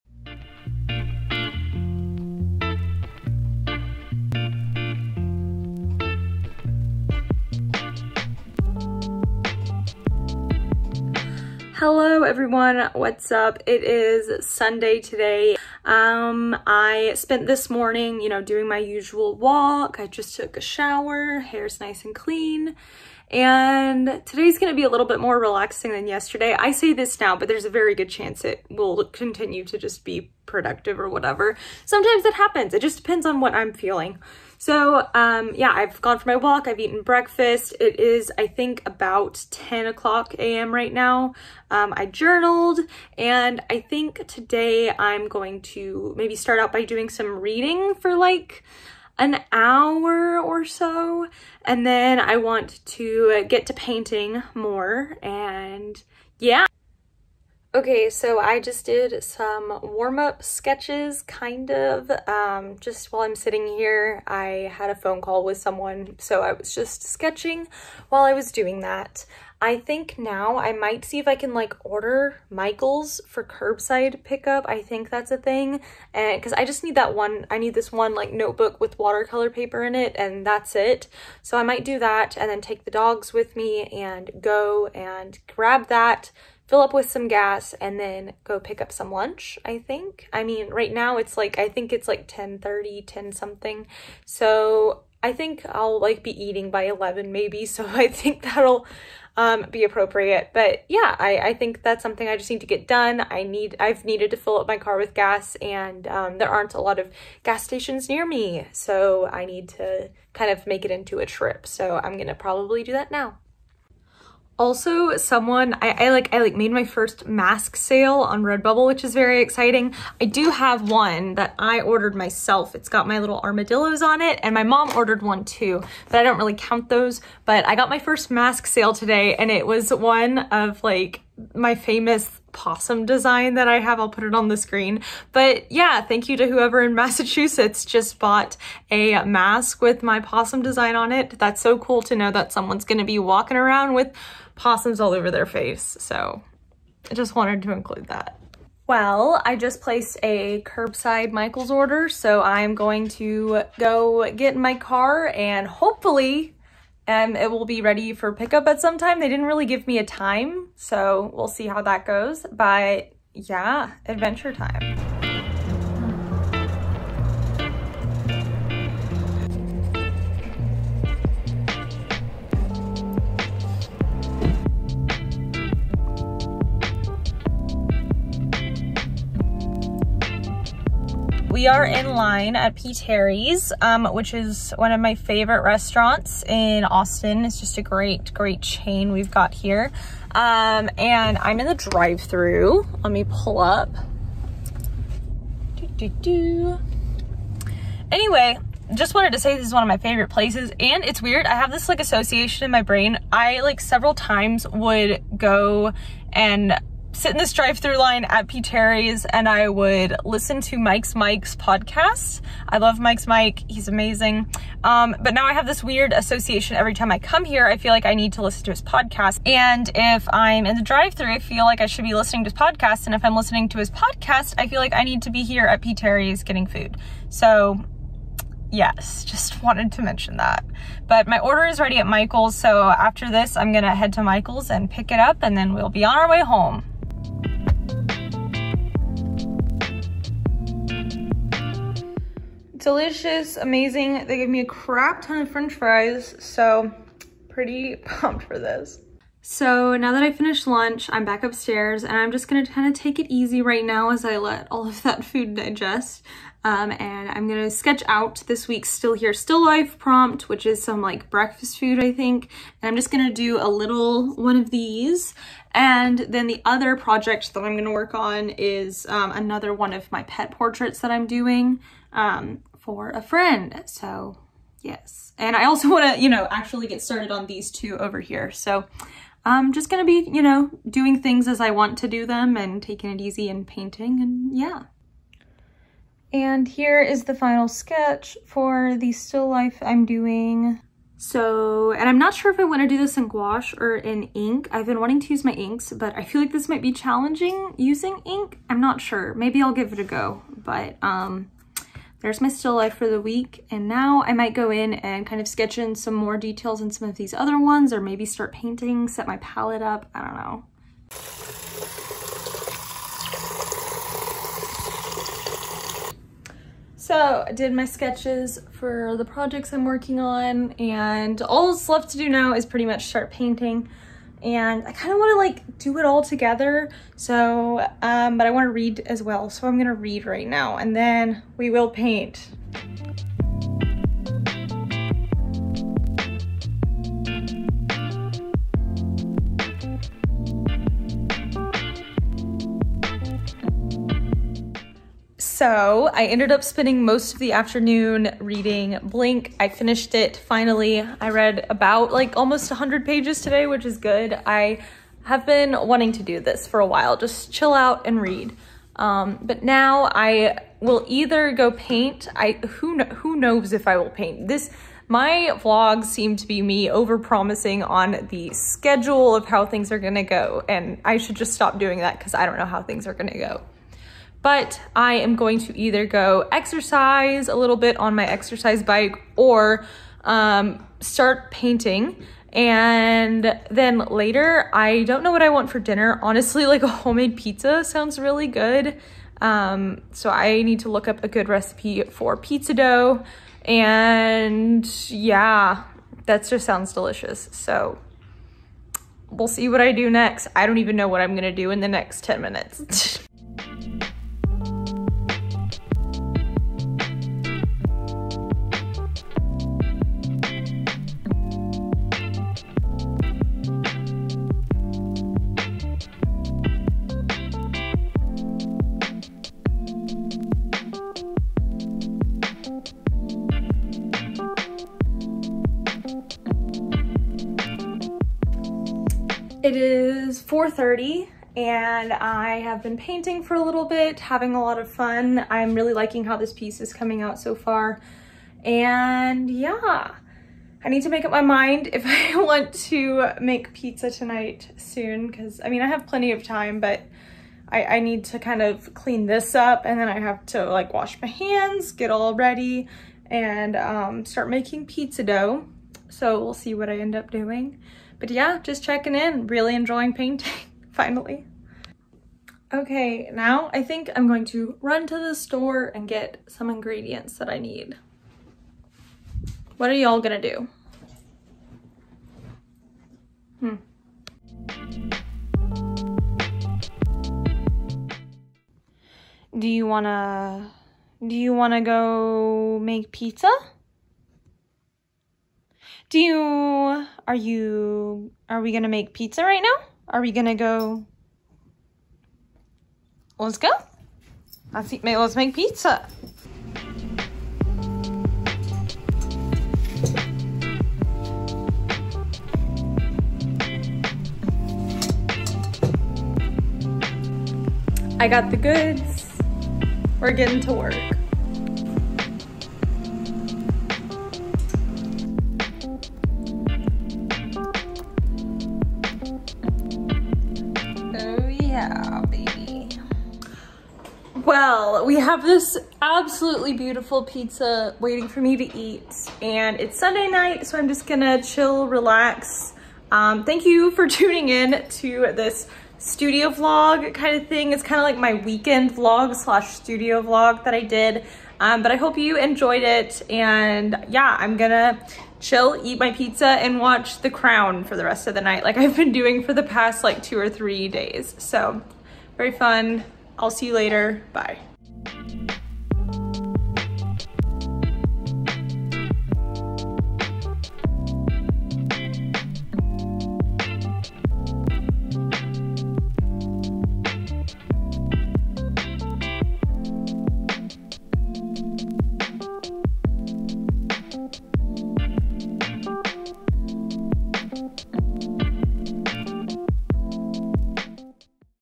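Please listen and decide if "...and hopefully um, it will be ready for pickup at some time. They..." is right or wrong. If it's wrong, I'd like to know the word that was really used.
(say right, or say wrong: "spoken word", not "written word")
right.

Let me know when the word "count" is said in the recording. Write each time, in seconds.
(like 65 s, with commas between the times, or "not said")
126 s.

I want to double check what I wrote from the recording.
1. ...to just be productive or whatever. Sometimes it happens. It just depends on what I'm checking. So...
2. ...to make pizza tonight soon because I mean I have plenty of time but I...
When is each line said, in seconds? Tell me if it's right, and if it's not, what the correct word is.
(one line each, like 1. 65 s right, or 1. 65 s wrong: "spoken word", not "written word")
1. 29 s wrong: "feeling", not "checking"
2. 442 s right.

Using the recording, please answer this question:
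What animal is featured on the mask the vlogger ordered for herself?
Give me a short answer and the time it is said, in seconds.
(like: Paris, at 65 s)
armadillos, at 123 s.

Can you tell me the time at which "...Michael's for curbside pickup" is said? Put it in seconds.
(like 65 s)
72 s.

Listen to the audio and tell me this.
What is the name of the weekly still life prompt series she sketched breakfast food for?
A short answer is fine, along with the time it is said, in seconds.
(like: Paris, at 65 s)
Still Here Still Life, at 258 s.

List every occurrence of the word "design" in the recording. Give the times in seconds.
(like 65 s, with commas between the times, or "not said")
133 s, 140 s.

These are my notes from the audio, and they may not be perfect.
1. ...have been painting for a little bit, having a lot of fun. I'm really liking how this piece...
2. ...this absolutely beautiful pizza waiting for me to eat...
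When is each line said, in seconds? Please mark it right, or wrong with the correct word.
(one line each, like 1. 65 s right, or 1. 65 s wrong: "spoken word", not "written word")
1. 432 s right
2. 525 s right.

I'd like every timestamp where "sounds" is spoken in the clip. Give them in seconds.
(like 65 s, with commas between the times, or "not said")
387 s, 396 s.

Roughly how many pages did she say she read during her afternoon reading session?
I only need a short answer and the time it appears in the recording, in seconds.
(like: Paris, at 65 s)
100, at 352 s.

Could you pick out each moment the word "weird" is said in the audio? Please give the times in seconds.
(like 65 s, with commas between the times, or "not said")
201 s, 215 s.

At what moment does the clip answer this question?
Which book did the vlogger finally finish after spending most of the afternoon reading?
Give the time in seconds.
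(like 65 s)
349 s.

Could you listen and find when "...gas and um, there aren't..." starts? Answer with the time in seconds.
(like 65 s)
105 s.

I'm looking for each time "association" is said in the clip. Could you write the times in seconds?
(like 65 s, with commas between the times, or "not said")
202 s, 216 s.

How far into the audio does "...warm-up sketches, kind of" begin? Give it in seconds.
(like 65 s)
59 s.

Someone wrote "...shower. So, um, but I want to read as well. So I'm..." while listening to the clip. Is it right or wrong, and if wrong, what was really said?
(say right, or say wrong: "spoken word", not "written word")
wrong: "together", not "shower".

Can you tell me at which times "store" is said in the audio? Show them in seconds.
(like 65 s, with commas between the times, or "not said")
465 s.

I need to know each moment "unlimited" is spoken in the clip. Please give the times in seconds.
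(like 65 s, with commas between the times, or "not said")
not said.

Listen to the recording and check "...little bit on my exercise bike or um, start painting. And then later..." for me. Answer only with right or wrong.
right.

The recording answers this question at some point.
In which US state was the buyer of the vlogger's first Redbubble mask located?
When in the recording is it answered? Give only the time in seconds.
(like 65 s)
136 s.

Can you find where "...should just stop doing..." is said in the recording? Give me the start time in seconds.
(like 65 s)
371 s.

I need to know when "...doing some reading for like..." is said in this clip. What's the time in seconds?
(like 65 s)
46 s.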